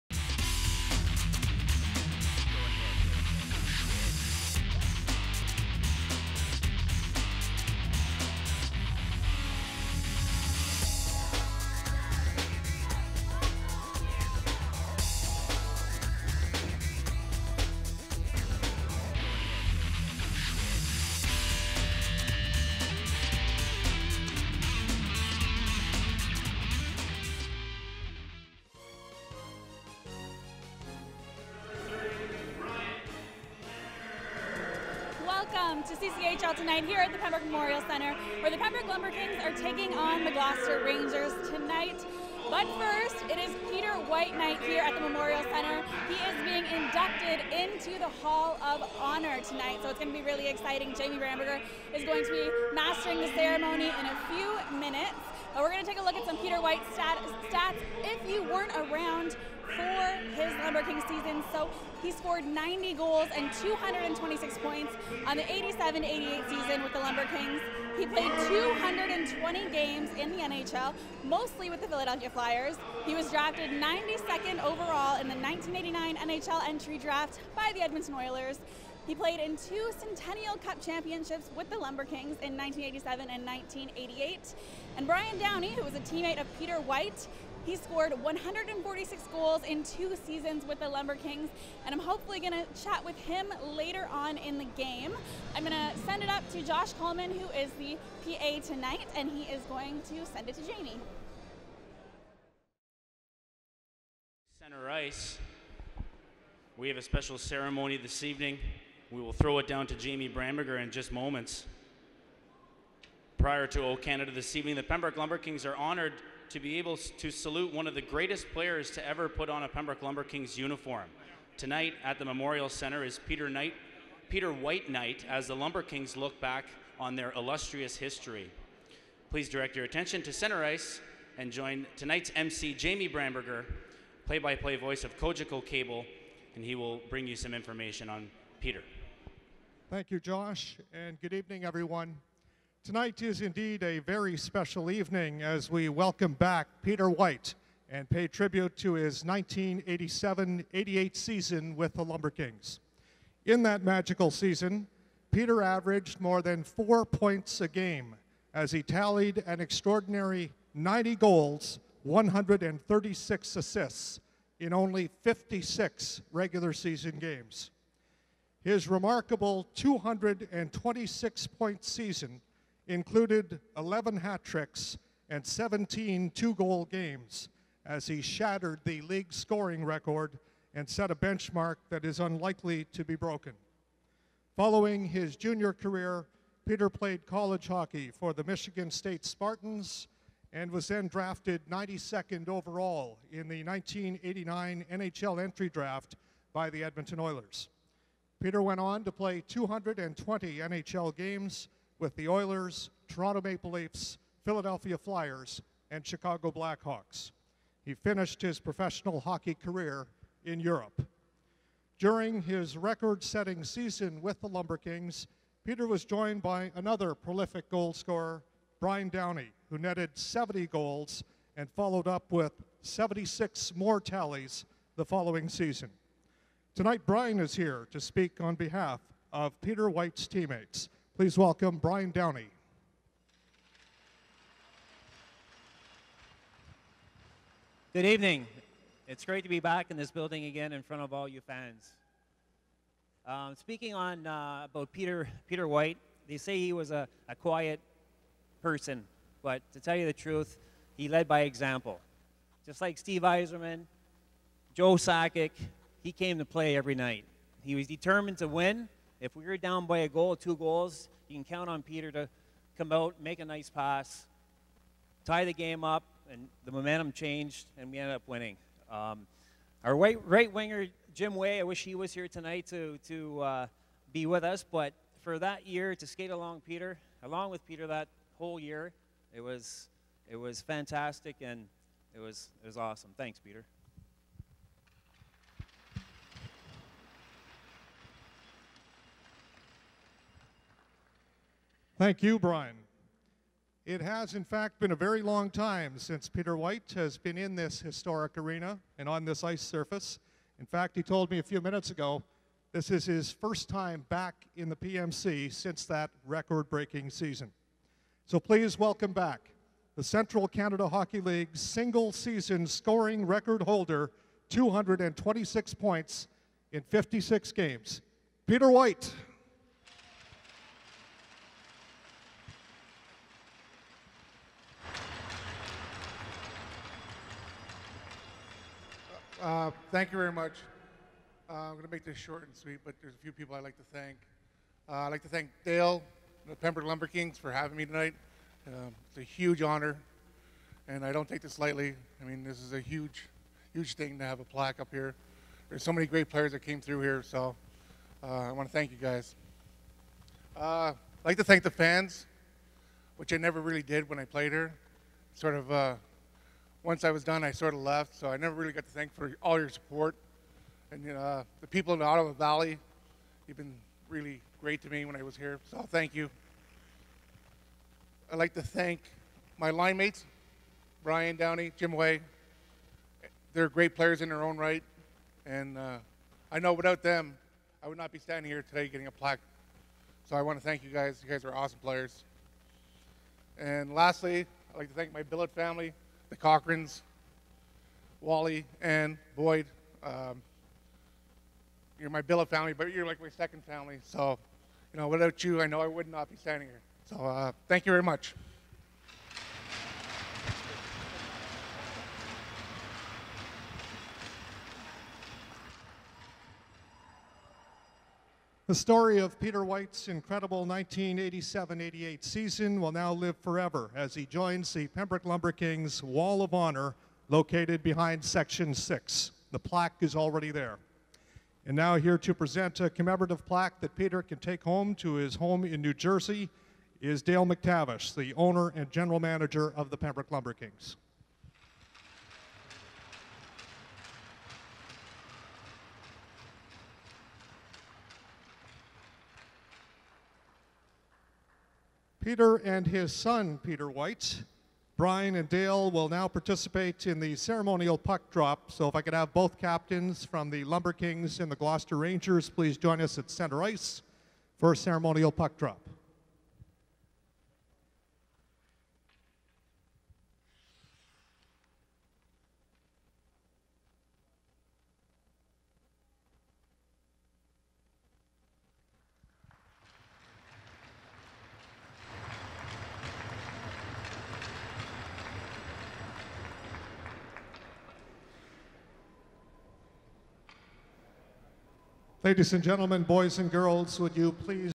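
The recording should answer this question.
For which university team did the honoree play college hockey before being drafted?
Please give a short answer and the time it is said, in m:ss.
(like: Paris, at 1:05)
Michigan State Spartans, at 3:08.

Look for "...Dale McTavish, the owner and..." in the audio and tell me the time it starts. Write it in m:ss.
7:07.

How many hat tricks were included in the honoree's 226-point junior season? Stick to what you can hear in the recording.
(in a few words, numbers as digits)
11.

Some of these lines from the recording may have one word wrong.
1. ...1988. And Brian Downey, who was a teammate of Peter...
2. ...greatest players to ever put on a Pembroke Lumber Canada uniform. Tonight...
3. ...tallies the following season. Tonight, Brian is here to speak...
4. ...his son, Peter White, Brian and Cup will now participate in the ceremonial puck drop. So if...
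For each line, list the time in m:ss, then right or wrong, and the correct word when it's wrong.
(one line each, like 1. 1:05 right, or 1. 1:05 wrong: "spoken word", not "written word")
1. 1:23 right
2. 1:58 wrong: "Kings", not "Canada"
3. 3:44 right
4. 7:22 wrong: "Dale", not "Cup".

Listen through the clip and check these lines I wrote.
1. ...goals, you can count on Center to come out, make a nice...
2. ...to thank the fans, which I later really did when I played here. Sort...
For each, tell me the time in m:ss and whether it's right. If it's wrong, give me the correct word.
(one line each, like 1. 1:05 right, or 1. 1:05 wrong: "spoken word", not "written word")
1. 4:20 wrong: "Peter", not "Center"
2. 5:51 wrong: "never", not "later".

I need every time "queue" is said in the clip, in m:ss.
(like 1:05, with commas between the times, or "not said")
not said.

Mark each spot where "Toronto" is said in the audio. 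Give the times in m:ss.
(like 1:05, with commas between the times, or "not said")
3:23.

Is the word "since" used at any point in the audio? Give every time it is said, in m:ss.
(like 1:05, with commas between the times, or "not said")
4:55, 5:05.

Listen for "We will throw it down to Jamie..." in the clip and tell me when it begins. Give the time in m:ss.
1:49.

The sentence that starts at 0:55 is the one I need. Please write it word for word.
But we're going to take a look at some Peter White stat stats if you weren't around for his Lumber King season.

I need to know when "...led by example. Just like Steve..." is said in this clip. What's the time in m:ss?
4:11.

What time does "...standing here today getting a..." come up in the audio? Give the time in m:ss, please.
6:18.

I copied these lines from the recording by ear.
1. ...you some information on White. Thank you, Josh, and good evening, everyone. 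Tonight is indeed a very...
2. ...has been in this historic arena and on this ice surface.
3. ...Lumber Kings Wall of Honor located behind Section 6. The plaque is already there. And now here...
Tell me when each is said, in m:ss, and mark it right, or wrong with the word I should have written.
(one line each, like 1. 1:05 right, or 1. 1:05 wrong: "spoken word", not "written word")
1. 2:17 wrong: "Peter", not "White"
2. 4:56 right
3. 6:55 right.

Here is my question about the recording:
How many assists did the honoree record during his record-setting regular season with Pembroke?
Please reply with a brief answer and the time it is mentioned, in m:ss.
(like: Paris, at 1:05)
136, at 2:42.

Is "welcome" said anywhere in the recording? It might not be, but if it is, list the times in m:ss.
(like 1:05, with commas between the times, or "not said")
0:35, 2:25, 3:51, 5:08.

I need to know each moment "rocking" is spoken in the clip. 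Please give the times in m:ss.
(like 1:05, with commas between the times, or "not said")
not said.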